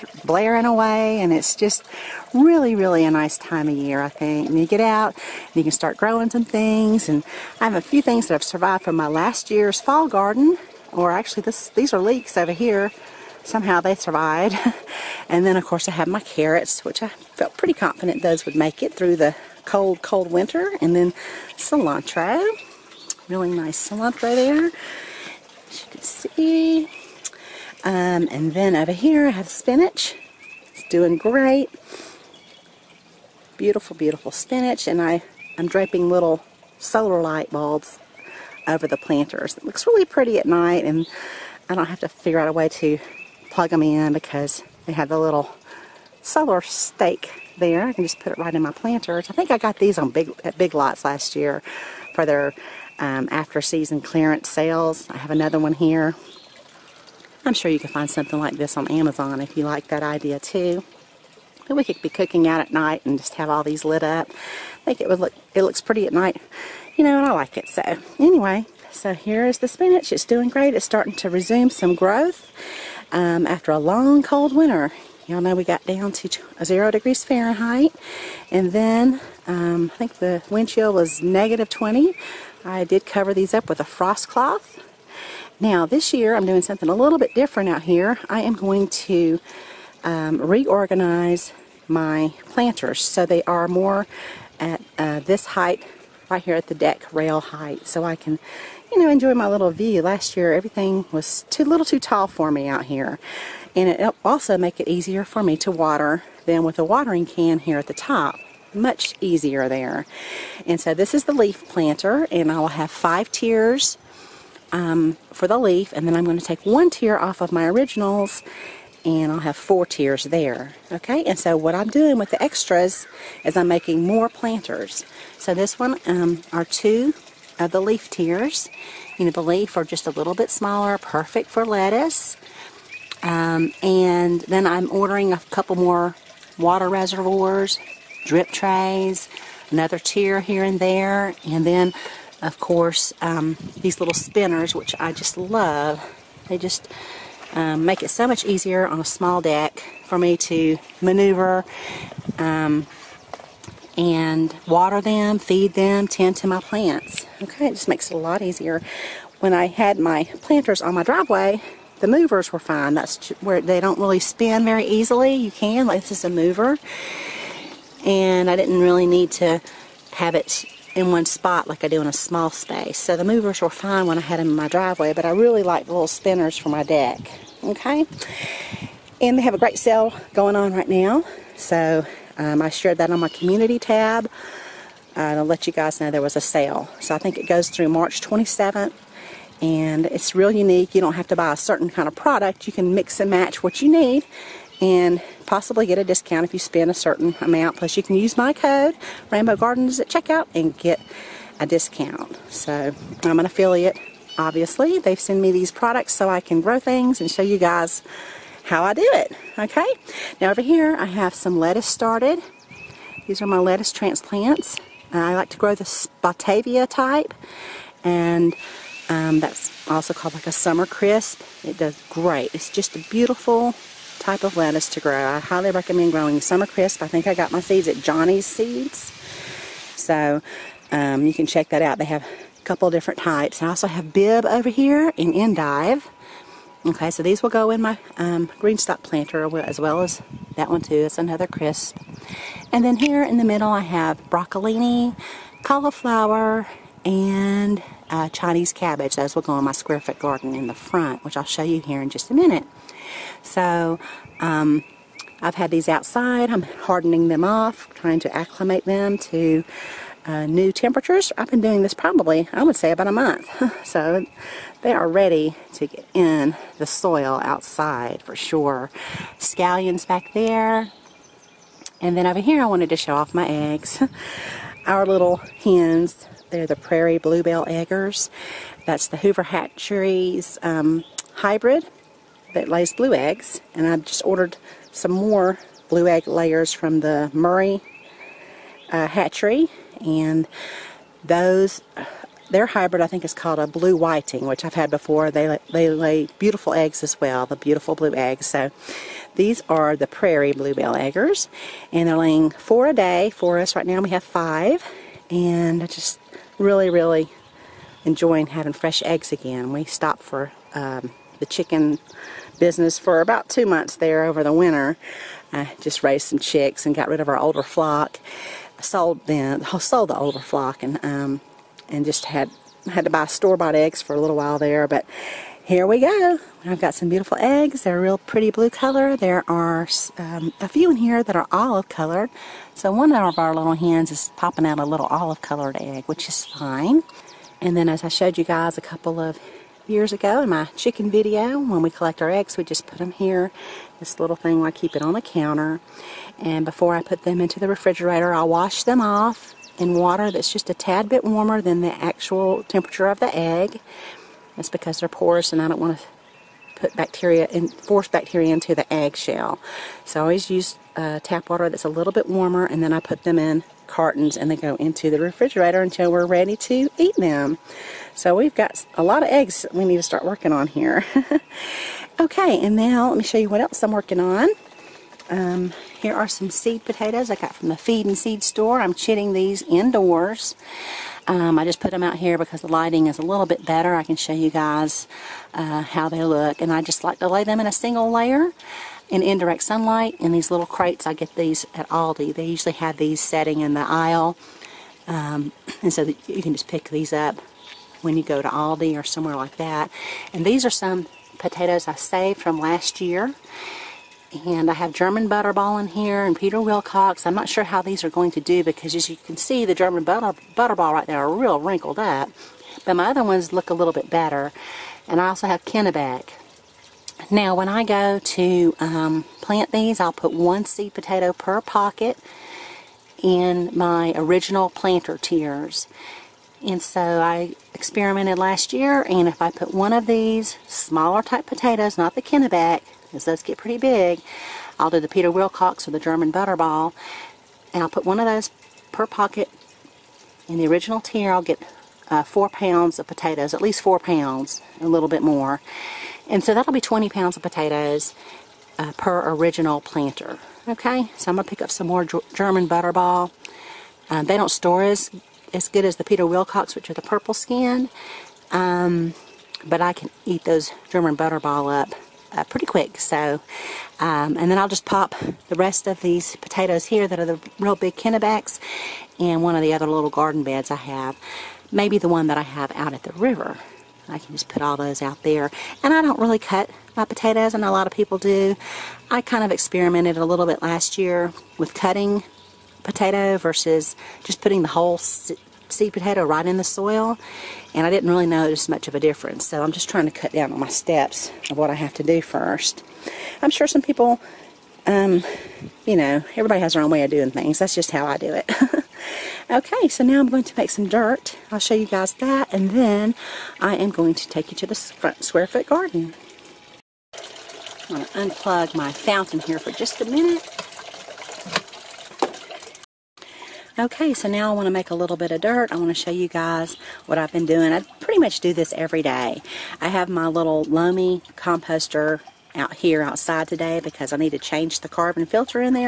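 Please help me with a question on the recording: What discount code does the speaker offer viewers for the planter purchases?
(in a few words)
Rainbow Gardens.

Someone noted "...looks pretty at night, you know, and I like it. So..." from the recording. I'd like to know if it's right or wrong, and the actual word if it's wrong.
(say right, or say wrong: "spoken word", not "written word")
right.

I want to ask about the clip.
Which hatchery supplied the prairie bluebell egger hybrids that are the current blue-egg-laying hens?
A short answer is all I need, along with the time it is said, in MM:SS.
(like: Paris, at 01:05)
Hoover Hatcheries, at 04:39.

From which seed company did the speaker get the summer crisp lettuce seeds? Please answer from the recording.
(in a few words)
Johnny's Seeds.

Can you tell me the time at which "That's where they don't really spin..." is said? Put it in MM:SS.
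02:42.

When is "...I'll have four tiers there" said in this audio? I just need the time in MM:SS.
01:59.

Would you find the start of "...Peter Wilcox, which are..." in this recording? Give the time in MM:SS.
07:36.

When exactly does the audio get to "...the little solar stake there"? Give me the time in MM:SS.
00:45.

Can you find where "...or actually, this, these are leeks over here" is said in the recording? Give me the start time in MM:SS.
00:10.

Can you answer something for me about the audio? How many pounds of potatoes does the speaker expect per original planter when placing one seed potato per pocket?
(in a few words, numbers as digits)
20.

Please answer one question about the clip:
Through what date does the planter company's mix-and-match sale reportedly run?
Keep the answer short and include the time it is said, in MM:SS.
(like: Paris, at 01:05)
March 27th, at 03:07.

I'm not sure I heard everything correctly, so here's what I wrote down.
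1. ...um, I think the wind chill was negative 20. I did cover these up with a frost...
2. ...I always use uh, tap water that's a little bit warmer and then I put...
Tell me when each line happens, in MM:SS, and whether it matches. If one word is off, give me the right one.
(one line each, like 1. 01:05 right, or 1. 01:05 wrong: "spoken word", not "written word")
1. 01:19 right
2. 06:00 right.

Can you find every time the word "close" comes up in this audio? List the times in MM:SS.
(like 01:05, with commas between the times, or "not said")
not said.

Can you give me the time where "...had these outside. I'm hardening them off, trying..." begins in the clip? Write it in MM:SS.
04:15.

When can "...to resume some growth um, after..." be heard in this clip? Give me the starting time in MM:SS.
01:11.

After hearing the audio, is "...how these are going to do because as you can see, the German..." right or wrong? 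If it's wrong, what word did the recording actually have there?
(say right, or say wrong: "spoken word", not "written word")
right.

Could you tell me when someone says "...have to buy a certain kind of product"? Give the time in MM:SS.
03:11.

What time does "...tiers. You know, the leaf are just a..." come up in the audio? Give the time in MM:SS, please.
02:08.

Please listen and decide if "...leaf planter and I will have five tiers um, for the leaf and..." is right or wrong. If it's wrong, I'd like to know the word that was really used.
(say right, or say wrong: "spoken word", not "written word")
right.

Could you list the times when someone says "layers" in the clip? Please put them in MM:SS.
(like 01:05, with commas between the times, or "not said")
04:46, 06:28.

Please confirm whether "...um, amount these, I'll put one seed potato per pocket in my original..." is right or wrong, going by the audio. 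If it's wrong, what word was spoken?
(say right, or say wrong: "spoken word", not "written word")
wrong: "plant", not "amount".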